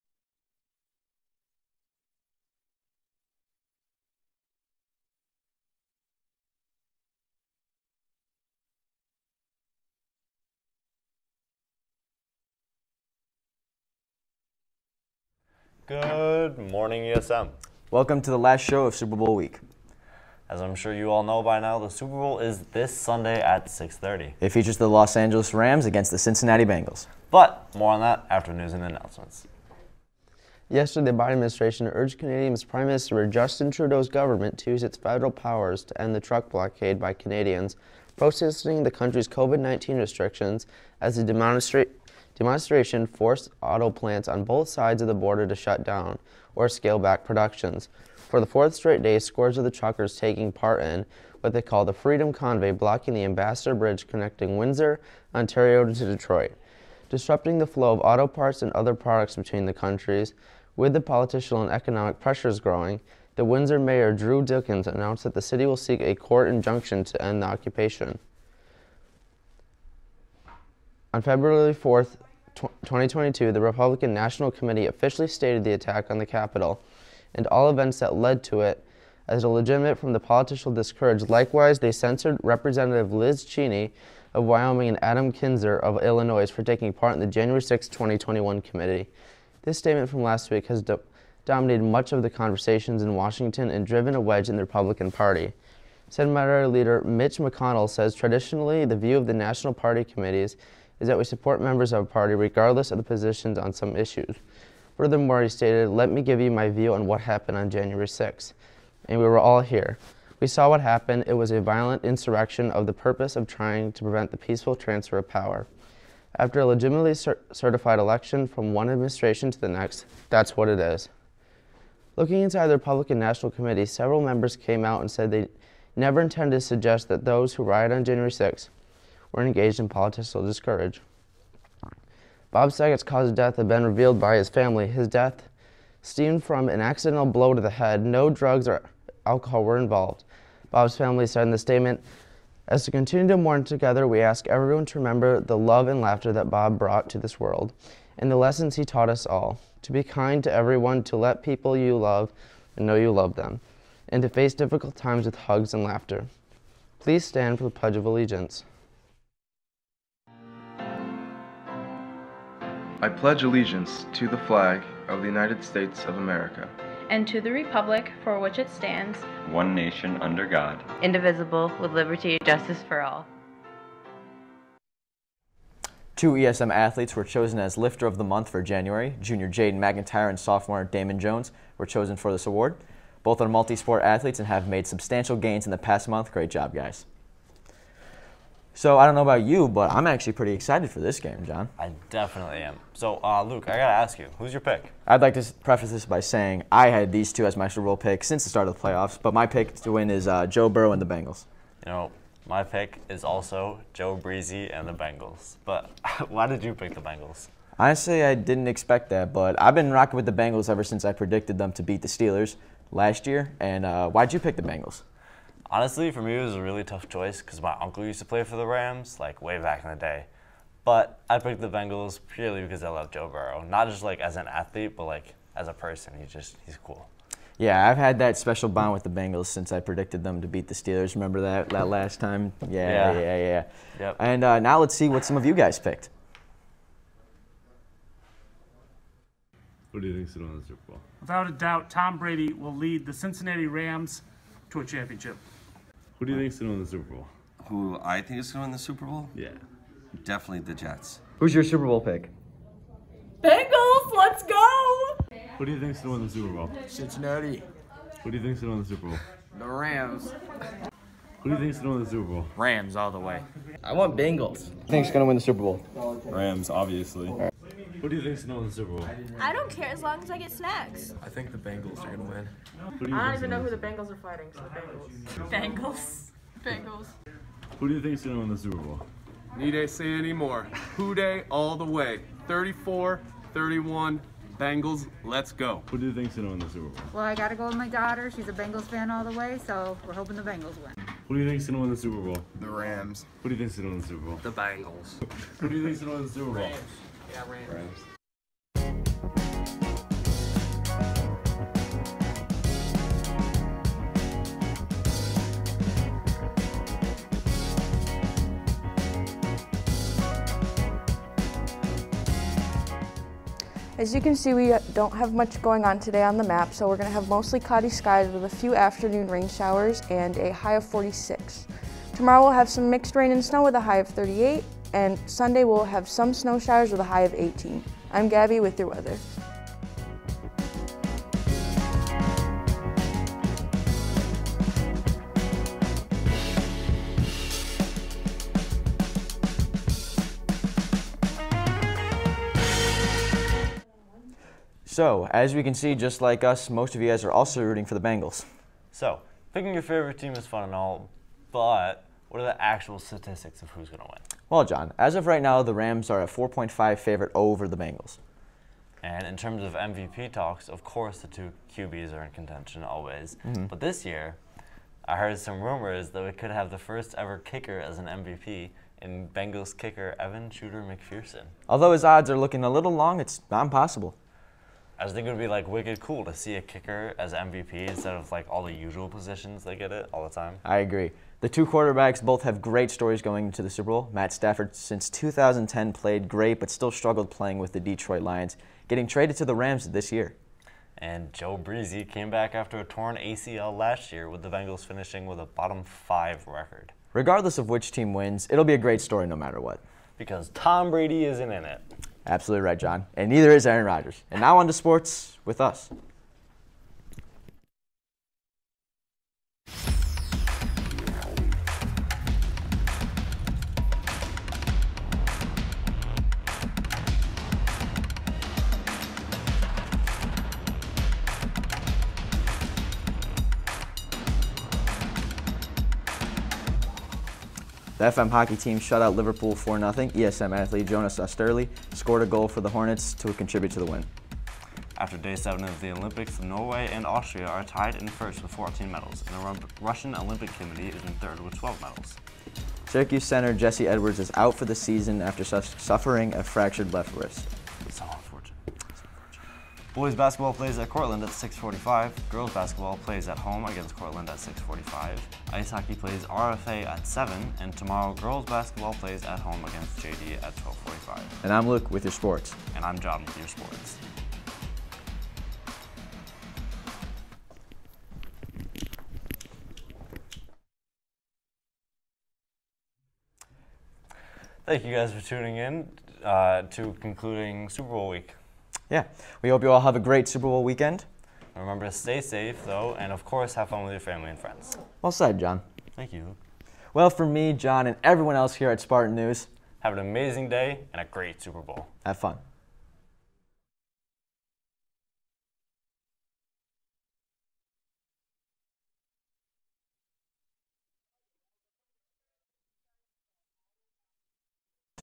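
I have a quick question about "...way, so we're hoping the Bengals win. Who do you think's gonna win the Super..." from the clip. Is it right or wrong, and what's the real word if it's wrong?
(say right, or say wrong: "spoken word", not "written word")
right.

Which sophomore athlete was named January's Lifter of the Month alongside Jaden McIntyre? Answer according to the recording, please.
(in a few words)
Damon Jones.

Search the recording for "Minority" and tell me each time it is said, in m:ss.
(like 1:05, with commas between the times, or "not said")
1:36.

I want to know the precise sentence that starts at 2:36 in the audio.
Please stand for the Pledge of Allegiance.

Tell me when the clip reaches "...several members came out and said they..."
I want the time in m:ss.
2:03.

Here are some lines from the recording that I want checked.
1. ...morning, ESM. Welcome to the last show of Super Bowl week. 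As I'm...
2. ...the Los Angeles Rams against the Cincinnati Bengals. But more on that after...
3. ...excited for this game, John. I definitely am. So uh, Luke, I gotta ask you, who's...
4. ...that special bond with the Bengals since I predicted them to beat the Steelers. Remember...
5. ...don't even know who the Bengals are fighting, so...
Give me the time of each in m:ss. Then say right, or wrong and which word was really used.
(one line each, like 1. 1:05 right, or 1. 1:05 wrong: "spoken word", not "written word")
1. 0:16 right
2. 0:24 right
3. 3:10 right
4. 3:48 right
5. 4:33 right.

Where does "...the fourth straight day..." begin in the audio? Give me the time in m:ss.
0:48.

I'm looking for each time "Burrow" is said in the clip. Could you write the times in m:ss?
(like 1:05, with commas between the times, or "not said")
3:20, 3:43.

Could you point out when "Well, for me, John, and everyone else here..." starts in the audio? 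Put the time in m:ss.
8:06.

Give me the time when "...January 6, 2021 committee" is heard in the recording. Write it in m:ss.
1:27.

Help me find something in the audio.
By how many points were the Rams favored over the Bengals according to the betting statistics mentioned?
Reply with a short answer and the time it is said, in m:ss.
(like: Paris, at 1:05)
4.5, at 5:56.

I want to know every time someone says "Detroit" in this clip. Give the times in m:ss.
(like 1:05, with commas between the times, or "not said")
0:56, 6:27.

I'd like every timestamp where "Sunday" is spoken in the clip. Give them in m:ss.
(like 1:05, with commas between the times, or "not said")
0:22, 5:25.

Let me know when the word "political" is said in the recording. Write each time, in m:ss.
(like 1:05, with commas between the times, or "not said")
1:01, 1:20, 2:09.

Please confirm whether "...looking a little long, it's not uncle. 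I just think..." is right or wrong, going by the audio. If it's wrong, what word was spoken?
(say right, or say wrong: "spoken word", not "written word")
wrong: "impossible", not "uncle".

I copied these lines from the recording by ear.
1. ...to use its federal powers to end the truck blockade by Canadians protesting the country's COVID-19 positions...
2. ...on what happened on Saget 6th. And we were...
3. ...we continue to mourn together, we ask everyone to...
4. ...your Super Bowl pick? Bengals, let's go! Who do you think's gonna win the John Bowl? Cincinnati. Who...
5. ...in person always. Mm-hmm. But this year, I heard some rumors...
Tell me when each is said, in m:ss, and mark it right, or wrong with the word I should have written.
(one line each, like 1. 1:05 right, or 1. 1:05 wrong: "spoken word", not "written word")
1. 0:34 wrong: "restrictions", not "positions"
2. 1:46 wrong: "January", not "Saget"
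3. 2:22 right
4. 4:11 wrong: "Super", not "John"
5. 6:02 wrong: "contention", not "person".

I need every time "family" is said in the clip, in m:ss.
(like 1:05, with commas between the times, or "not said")
2:14, 2:20, 8:04.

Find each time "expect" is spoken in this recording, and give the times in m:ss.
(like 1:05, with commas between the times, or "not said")
3:28.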